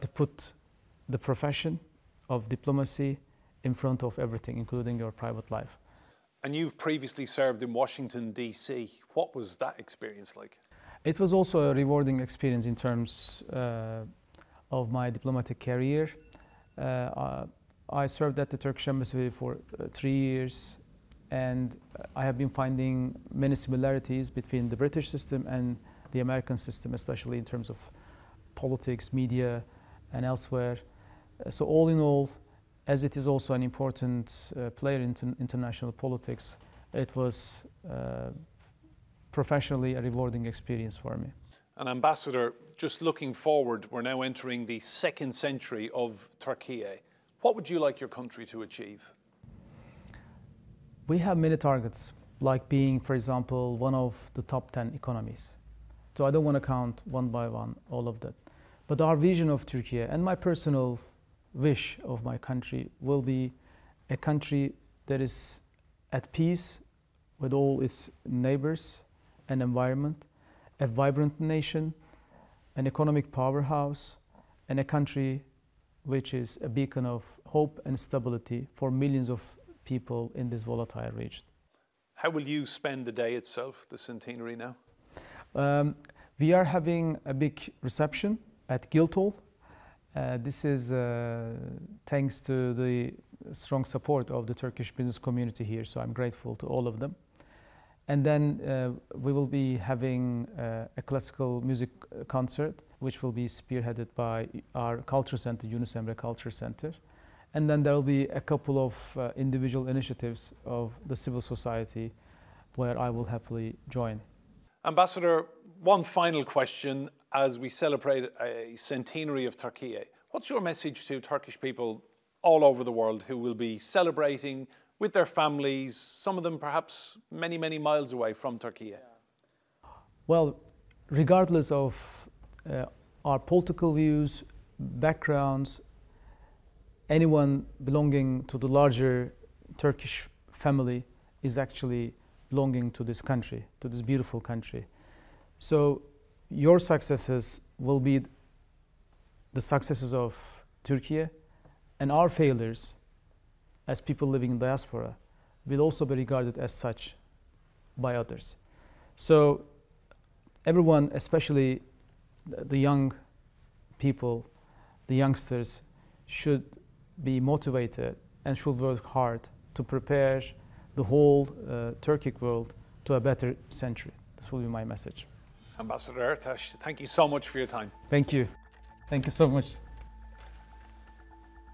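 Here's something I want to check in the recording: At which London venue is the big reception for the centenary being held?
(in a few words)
Guildhall.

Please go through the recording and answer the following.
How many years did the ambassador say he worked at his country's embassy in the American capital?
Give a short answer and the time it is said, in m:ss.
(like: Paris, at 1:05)
3, at 0:19.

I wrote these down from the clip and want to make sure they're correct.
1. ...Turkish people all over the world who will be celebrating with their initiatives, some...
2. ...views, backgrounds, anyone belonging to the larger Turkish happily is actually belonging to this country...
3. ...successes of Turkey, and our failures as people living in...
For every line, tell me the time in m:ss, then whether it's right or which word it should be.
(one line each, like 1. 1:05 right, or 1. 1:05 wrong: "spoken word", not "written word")
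1. 2:01 wrong: "families", not "initiatives"
2. 2:13 wrong: "family", not "happily"
3. 2:29 right.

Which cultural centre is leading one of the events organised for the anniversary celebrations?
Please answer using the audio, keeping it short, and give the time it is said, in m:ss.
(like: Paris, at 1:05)
Yunus Emre Culture Center, at 1:45.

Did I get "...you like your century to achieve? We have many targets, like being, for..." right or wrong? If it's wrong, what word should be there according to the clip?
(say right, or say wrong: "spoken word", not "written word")
wrong: "country", not "century".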